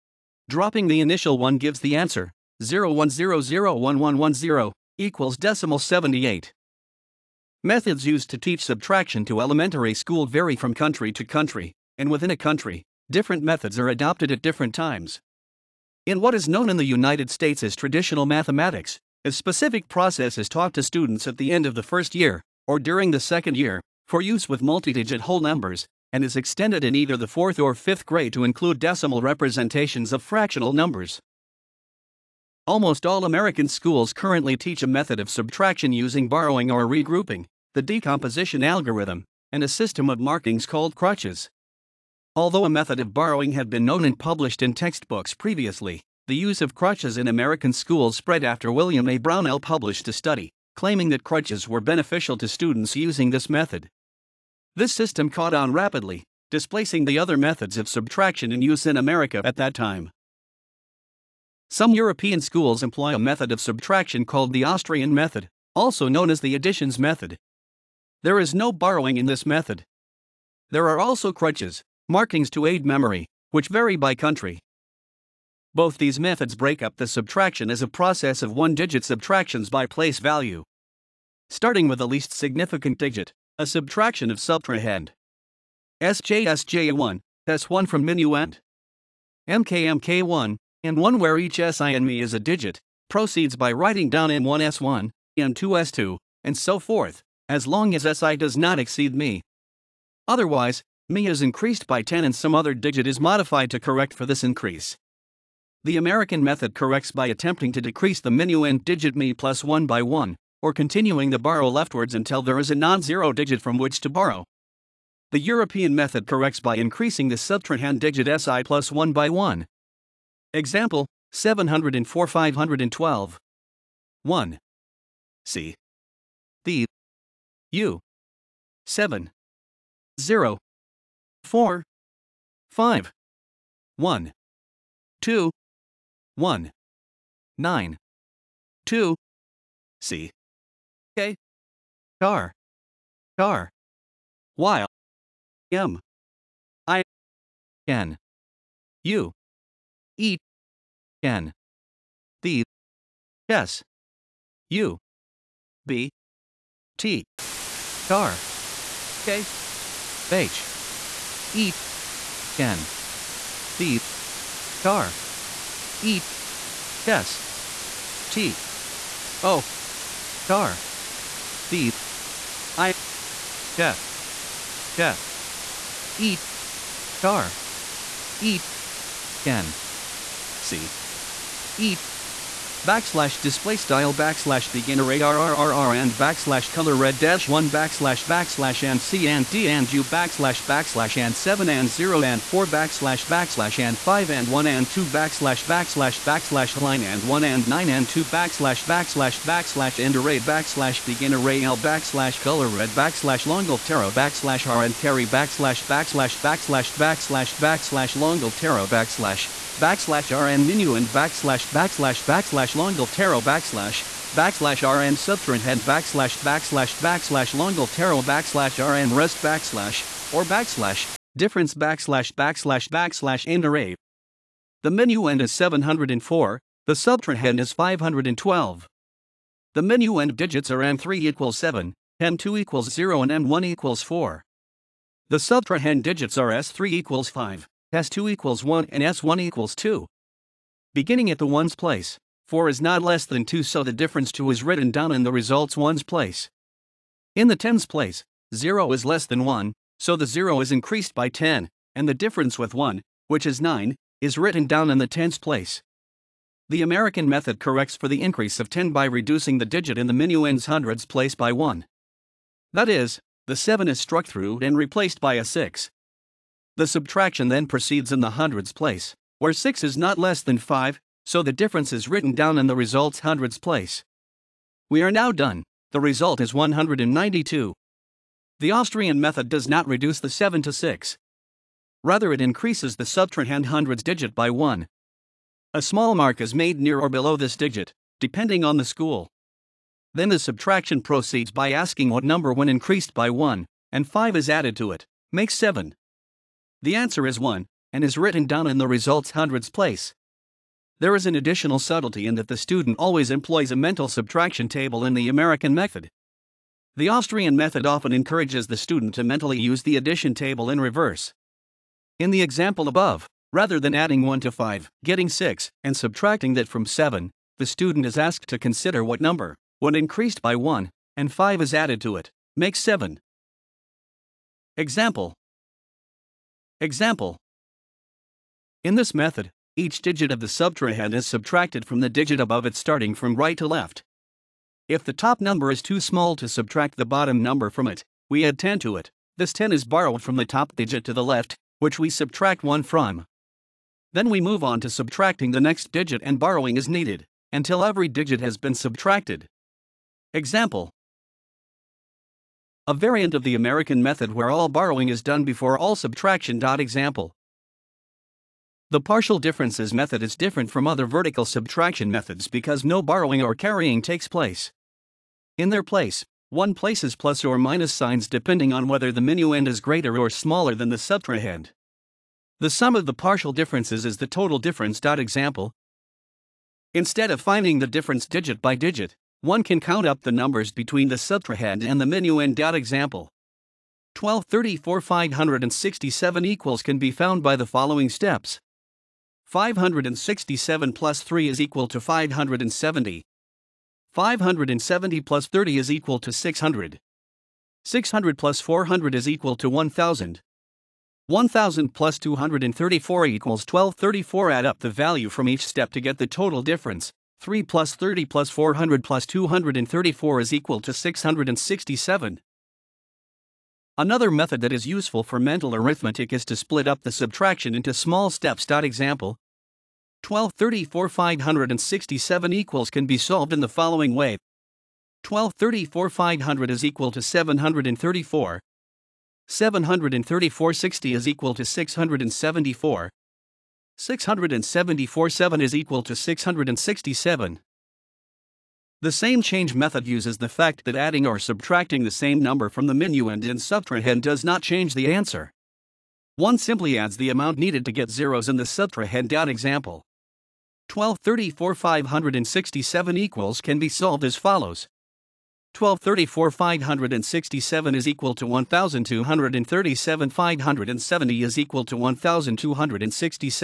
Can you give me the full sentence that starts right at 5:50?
Example a variant of the American method where all borrowing is done before all subtraction.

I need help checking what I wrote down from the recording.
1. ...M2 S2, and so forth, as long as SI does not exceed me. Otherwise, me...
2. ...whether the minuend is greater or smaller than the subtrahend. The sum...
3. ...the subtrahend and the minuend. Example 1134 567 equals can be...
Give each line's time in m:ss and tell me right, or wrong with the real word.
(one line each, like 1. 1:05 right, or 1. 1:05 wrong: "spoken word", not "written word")
1. 1:35 right
2. 6:08 right
3. 6:21 wrong: "1234", not "1134".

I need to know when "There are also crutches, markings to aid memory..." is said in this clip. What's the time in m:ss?
1:10.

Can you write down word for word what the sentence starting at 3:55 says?
The subtrahend digits are S3 equals 5.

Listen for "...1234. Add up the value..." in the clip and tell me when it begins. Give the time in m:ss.
6:43.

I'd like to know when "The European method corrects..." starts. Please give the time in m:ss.
1:55.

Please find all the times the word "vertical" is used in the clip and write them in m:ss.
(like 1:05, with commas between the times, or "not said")
6:01.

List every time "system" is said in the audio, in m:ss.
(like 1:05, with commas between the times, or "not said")
0:39, 0:54.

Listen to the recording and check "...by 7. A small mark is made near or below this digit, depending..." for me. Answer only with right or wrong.
wrong.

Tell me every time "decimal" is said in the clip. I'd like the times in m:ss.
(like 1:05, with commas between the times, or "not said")
0:05, 0:28.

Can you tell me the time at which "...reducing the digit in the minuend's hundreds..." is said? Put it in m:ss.
4:19.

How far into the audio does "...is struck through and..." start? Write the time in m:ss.
4:23.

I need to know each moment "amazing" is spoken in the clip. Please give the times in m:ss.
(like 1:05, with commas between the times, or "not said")
not said.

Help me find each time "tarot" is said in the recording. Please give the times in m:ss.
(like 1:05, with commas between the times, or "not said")
3:33, 3:37.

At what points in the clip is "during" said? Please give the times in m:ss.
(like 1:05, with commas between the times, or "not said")
0:22.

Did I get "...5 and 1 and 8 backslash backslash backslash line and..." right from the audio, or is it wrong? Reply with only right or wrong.
wrong.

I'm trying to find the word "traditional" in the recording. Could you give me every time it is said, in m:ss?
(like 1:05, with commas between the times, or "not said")
0:17.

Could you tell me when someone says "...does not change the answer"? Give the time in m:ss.
7:24.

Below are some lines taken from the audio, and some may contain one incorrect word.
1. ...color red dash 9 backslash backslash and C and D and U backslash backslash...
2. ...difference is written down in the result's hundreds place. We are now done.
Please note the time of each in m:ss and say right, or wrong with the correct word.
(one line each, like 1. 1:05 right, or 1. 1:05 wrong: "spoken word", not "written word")
1. 3:06 wrong: "1", not "9"
2. 4:31 right.